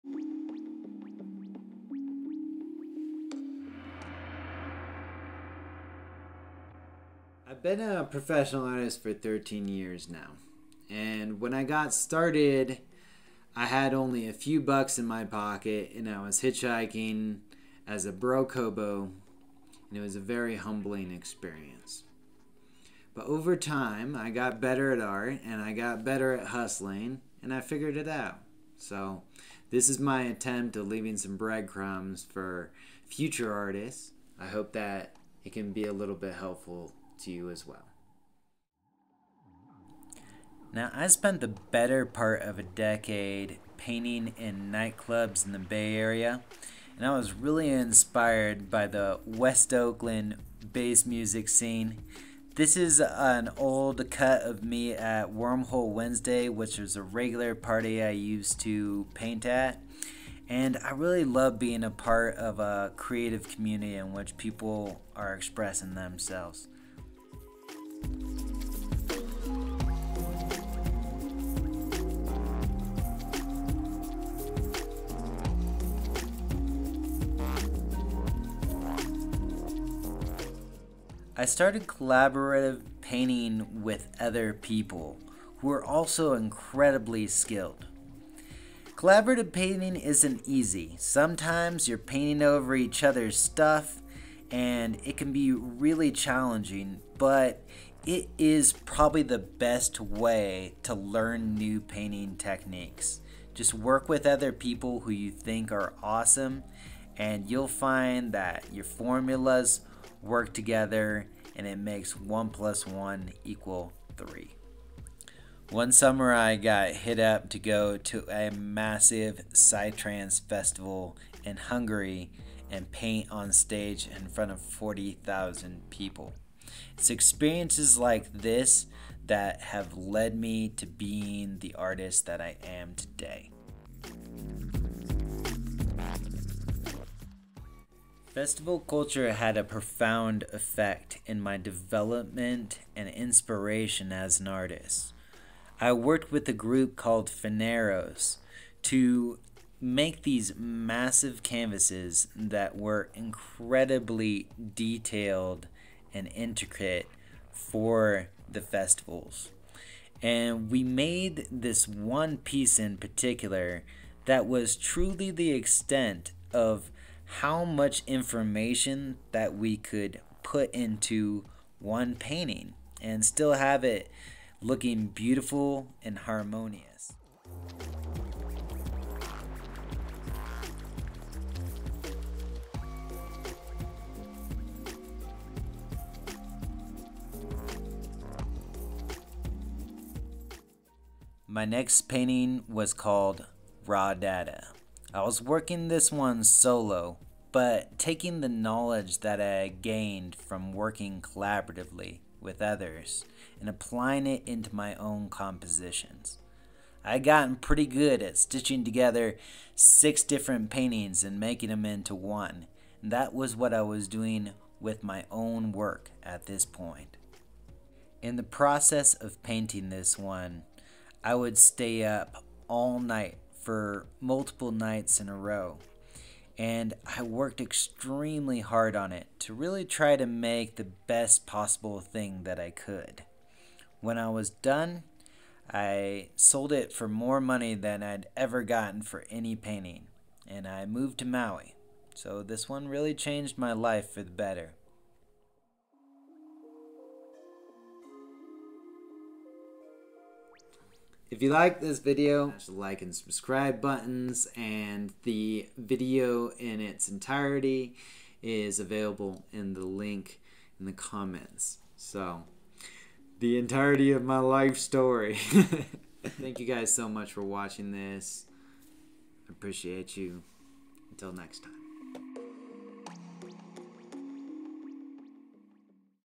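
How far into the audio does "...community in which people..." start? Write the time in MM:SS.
01:03.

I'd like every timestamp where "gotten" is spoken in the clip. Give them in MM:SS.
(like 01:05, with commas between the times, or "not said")
03:27, 03:58.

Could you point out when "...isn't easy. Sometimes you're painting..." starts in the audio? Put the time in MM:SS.
01:29.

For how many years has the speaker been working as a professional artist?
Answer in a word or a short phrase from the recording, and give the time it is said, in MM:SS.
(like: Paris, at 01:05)
13, at 00:09.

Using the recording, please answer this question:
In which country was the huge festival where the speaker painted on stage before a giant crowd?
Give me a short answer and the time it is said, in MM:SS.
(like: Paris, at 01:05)
Hungary, at 02:01.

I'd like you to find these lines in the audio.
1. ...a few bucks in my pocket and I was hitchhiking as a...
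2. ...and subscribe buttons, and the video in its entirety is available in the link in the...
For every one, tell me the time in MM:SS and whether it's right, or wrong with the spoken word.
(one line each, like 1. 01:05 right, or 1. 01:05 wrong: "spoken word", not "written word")
1. 00:14 right
2. 04:13 right.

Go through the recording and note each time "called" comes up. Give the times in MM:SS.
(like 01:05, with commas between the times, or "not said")
02:26, 03:12.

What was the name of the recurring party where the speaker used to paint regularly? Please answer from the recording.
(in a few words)
Wormhole Wednesday.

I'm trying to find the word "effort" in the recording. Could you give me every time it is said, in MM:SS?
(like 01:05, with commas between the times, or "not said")
not said.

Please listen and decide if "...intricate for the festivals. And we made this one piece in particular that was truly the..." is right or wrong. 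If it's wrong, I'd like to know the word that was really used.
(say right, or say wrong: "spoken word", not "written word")
right.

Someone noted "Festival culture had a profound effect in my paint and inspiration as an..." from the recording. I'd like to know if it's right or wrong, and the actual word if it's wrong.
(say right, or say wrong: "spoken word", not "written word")
wrong: "development", not "paint".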